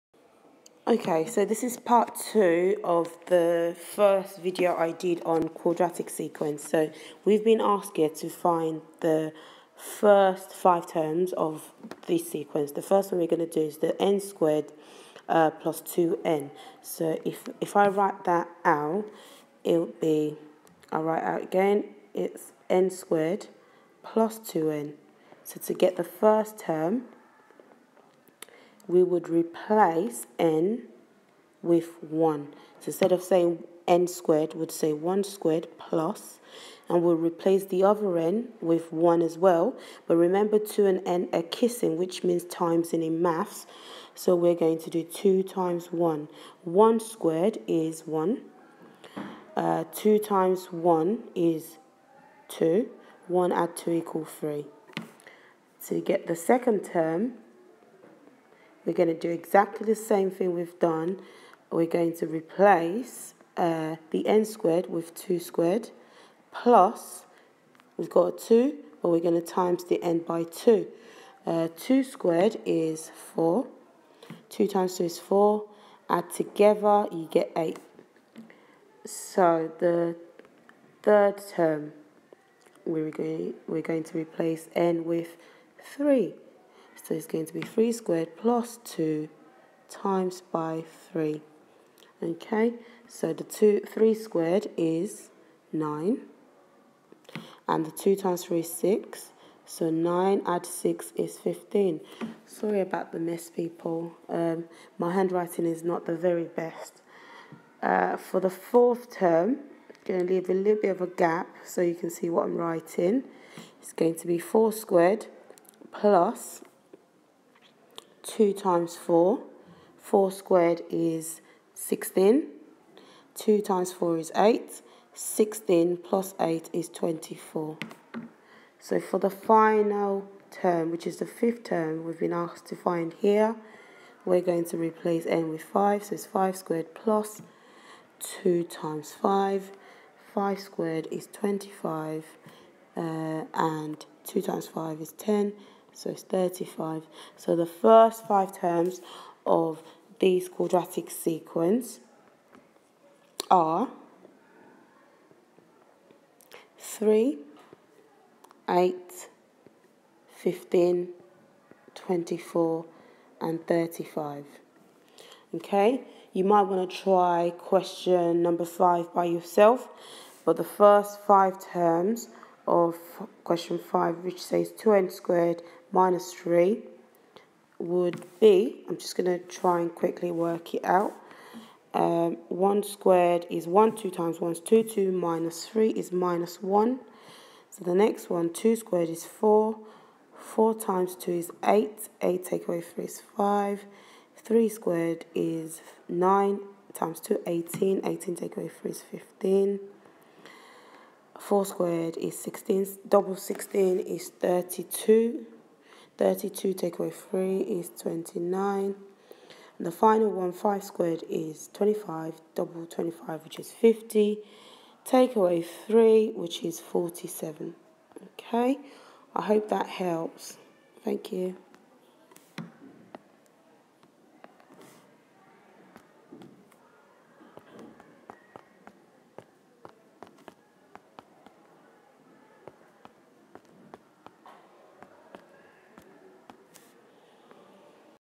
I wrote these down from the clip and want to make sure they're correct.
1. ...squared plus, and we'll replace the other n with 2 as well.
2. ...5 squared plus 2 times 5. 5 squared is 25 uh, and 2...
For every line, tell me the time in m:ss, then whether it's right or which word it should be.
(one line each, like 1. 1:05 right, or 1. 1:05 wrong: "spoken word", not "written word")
1. 0:35 wrong: "1", not "2"
2. 2:16 right.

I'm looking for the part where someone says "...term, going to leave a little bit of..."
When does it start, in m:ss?
1:49.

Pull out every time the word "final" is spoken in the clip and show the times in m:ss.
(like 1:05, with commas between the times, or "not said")
2:09, 3:29.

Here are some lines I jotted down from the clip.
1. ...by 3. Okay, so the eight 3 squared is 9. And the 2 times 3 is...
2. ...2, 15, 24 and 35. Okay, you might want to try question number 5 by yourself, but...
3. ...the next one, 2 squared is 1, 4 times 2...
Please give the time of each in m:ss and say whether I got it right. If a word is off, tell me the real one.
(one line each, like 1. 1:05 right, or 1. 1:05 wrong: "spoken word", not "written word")
1. 1:30 wrong: "two", not "eight"
2. 2:38 wrong: "8", not "2"
3. 3:07 wrong: "4", not "1".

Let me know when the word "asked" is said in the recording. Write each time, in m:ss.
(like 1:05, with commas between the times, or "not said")
0:07, 2:12.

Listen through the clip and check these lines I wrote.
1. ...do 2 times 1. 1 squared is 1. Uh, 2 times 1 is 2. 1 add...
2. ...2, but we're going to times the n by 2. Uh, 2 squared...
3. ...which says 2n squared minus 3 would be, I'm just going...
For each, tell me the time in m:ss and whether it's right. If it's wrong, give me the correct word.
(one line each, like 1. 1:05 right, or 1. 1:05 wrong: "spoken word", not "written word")
1. 0:44 right
2. 1:08 right
3. 2:54 right.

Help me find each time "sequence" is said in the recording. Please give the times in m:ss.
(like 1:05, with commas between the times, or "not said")
0:06, 0:12, 2:31.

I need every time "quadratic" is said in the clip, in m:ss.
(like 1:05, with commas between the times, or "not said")
0:05, 2:30.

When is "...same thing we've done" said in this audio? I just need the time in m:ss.
0:59.